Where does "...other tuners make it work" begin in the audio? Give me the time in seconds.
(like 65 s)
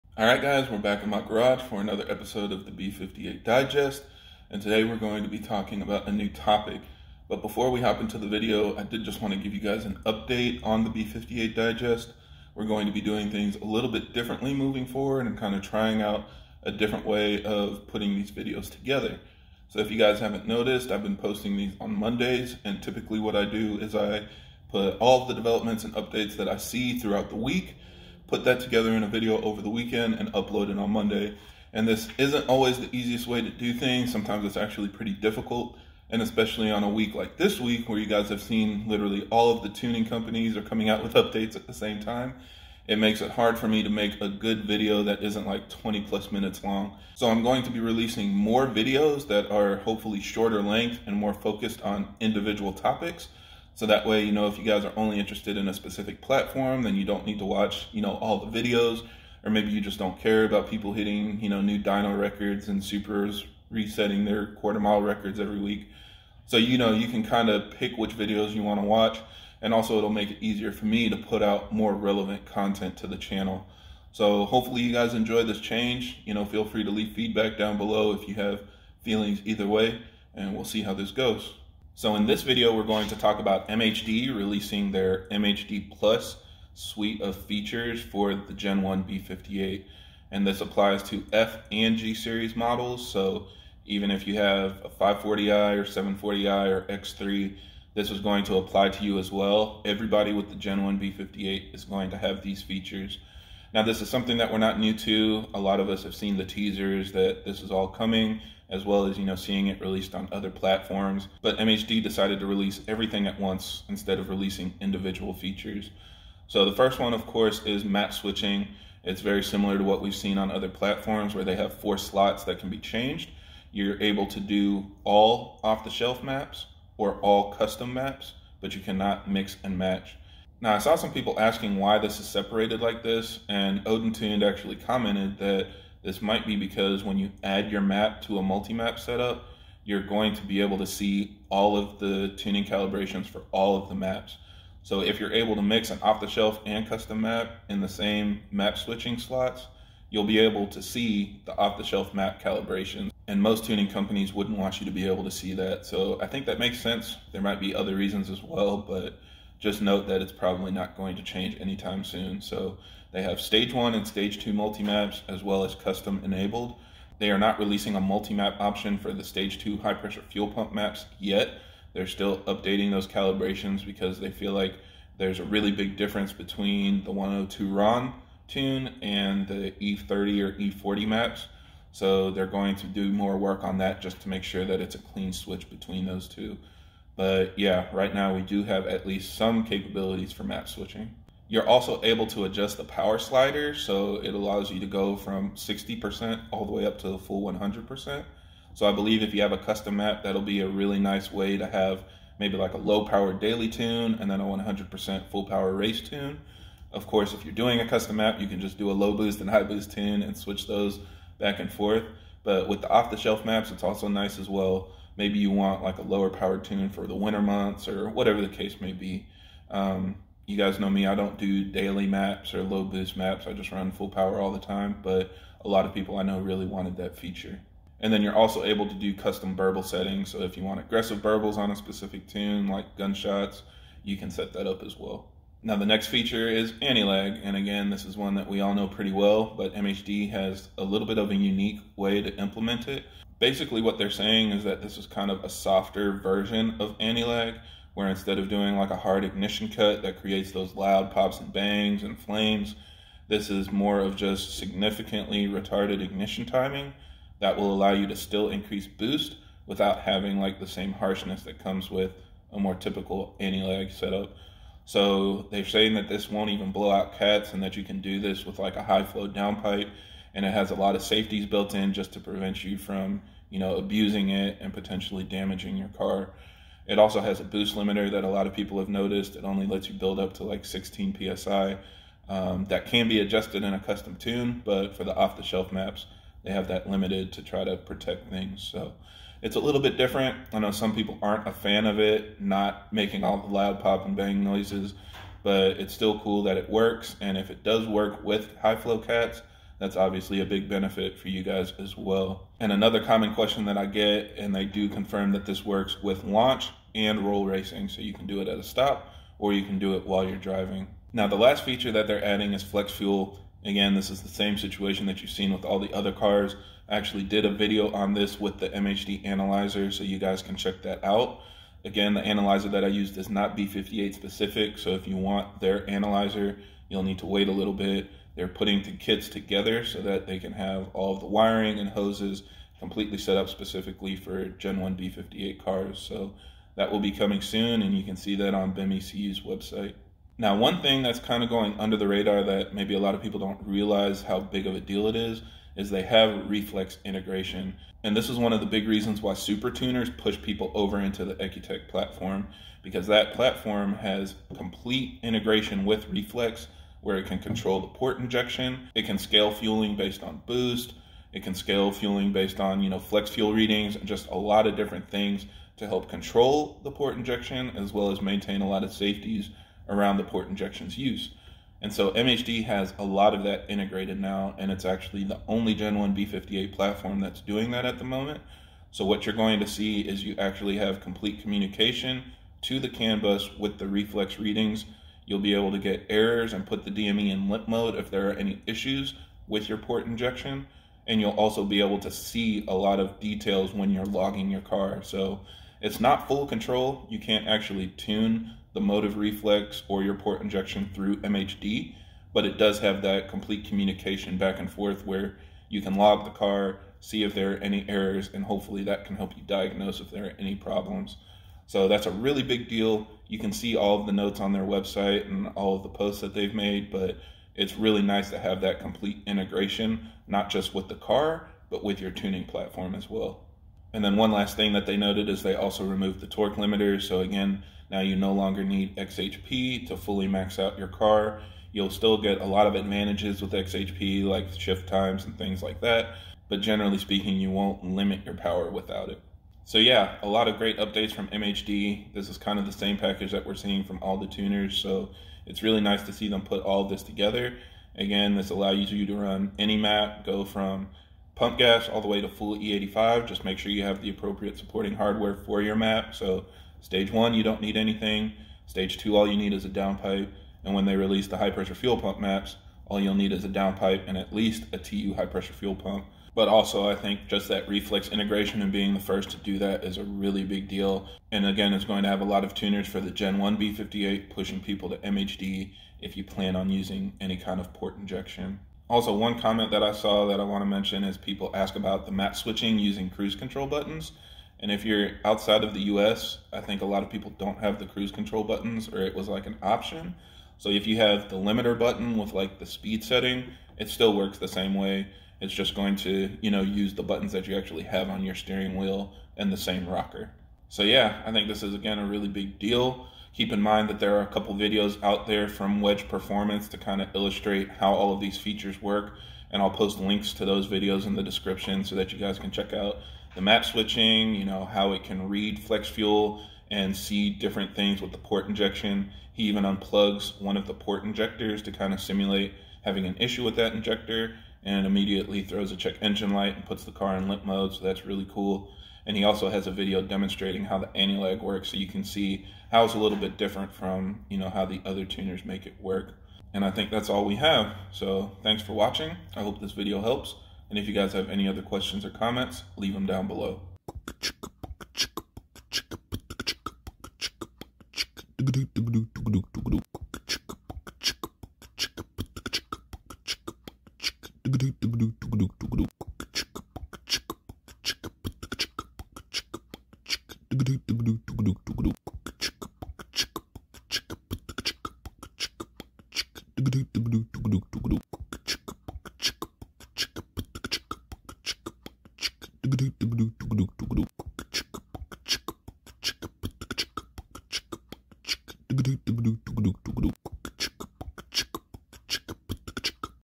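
534 s.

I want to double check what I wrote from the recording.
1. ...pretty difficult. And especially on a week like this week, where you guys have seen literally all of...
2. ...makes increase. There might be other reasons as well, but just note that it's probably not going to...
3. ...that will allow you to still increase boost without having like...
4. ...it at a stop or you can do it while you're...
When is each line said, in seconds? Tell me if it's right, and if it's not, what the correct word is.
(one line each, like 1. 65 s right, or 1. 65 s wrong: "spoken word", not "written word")
1. 34 s right
2. 156 s wrong: "sense", not "increase"
3. 257 s right
4. 308 s right.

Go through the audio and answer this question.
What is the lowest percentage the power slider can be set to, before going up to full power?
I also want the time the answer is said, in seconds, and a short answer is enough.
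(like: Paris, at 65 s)
60%, at 195 s.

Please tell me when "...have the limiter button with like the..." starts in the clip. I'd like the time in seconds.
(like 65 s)
490 s.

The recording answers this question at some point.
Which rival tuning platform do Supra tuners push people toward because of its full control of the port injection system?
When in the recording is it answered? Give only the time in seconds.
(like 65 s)
351 s.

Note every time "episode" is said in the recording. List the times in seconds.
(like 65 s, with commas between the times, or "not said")
2 s.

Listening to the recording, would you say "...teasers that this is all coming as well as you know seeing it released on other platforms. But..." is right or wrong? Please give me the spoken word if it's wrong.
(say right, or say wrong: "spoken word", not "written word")
right.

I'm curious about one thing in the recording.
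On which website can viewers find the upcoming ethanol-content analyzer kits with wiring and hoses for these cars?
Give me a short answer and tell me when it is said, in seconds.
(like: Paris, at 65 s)
BIM, at 338 s.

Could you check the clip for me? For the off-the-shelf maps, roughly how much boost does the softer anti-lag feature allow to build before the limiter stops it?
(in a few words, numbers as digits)
16 psi.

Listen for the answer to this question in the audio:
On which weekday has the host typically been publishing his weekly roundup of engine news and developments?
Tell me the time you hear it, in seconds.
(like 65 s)
21 s.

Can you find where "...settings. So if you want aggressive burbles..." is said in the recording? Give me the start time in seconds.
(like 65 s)
229 s.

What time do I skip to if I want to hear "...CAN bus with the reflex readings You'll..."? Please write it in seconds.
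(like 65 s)
382 s.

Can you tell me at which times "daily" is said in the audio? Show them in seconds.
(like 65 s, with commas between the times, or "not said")
203 s, 221 s.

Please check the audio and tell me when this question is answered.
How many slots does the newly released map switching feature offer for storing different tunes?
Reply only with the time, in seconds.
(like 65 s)
121 s.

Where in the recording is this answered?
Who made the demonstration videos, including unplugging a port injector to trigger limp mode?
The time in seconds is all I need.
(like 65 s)
505 s.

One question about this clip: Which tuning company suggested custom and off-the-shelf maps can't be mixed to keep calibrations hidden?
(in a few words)
Odin Tuned.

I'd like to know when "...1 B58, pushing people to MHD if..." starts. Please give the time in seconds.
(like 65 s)
473 s.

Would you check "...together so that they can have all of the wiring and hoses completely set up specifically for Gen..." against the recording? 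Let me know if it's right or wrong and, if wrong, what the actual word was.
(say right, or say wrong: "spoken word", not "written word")
right.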